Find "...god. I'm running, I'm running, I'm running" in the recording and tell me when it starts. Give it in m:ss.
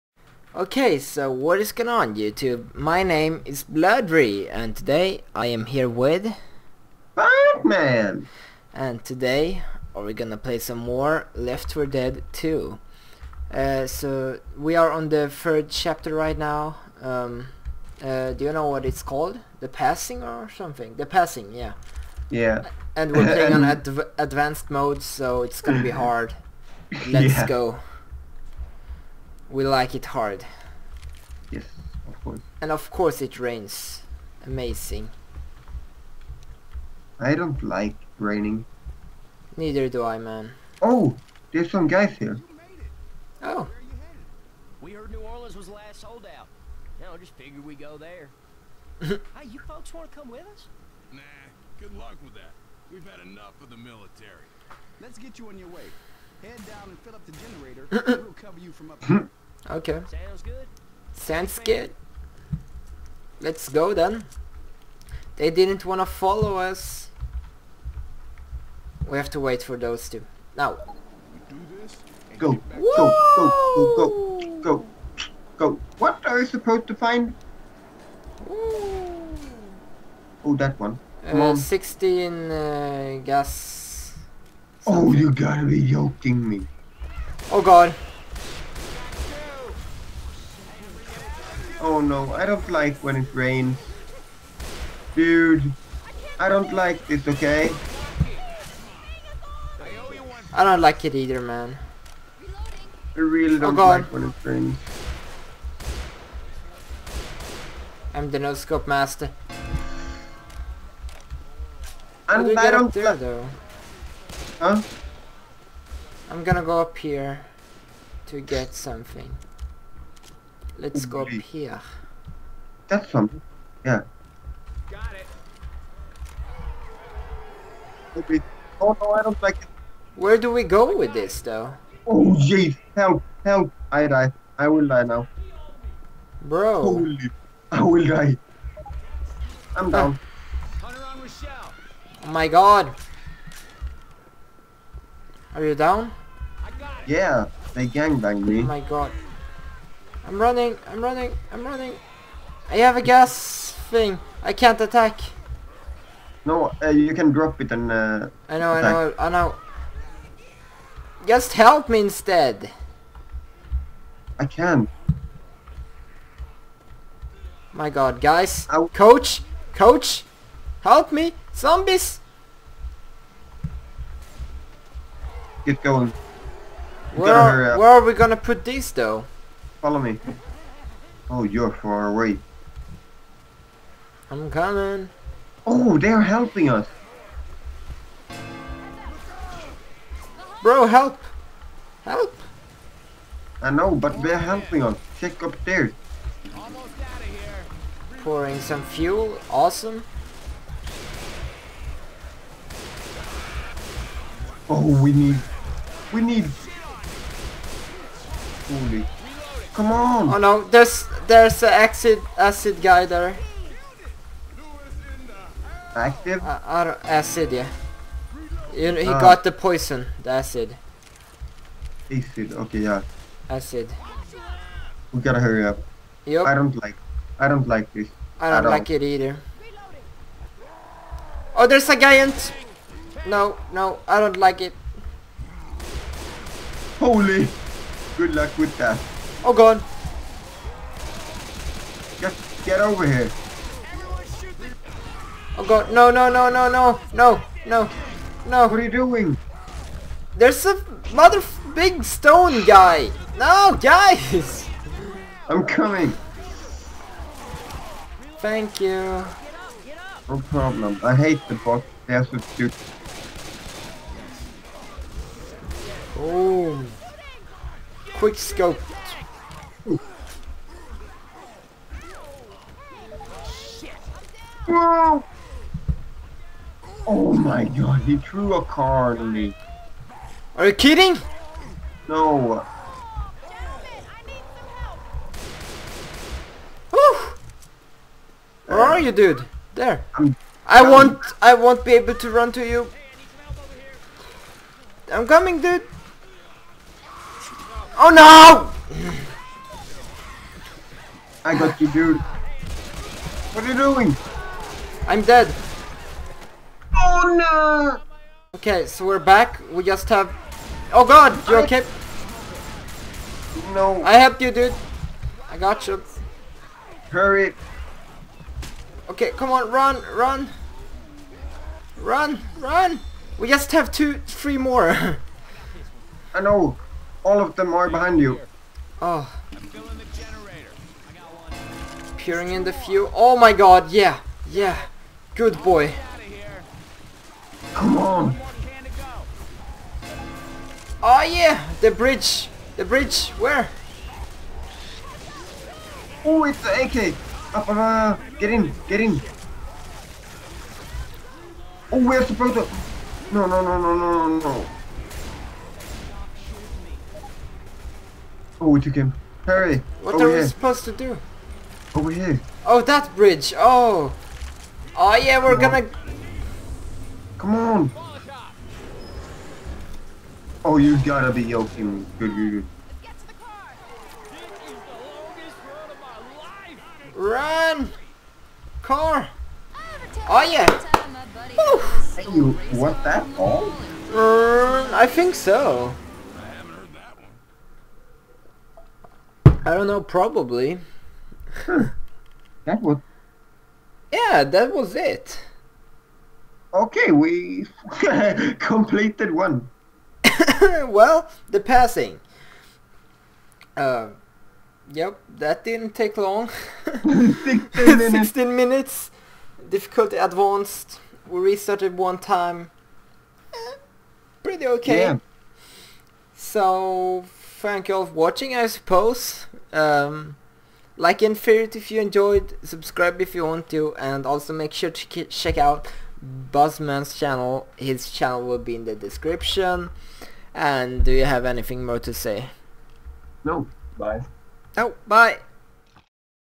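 2:28.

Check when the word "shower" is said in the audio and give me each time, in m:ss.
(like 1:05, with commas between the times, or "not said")
not said.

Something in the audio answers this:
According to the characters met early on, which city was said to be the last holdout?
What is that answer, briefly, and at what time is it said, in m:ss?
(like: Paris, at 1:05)
New Orleans, at 0:45.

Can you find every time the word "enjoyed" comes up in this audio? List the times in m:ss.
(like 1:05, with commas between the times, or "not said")
7:01.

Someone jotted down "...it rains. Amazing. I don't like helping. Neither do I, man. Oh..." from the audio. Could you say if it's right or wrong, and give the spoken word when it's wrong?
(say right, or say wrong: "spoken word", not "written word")
wrong: "raining", not "helping".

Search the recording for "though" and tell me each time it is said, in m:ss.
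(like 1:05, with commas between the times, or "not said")
1:53, 2:11, 2:58.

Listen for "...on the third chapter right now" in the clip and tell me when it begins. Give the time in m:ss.
0:14.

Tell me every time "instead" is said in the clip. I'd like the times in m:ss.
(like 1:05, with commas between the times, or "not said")
2:42.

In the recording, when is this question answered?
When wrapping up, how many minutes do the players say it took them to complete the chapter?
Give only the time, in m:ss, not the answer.
6:48.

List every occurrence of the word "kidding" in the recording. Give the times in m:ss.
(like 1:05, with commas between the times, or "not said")
4:40.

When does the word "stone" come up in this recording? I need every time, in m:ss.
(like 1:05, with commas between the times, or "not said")
4:12.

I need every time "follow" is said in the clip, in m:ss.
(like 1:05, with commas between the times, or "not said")
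1:06, 2:59.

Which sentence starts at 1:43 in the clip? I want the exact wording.
I really oh, don't oh like when it rains.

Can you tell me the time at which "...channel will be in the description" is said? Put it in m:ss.
7:08.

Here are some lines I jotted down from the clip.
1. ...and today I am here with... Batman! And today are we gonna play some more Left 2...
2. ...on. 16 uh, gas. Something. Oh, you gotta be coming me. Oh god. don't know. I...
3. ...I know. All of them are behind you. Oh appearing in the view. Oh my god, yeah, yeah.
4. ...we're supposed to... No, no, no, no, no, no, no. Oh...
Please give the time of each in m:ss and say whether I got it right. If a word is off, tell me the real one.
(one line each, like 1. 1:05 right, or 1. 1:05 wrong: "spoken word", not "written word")
1. 0:04 wrong: "4", not "2"
2. 1:21 wrong: "joking", not "coming"
3. 5:26 right
4. 5:52 right.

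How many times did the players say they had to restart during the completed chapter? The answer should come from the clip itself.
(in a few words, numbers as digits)
1.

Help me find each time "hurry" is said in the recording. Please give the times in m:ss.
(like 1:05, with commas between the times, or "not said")
3:45, 5:17, 5:59.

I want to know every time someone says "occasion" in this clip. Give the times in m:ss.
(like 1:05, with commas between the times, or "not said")
not said.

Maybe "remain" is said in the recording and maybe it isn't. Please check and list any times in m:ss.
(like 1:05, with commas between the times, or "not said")
not said.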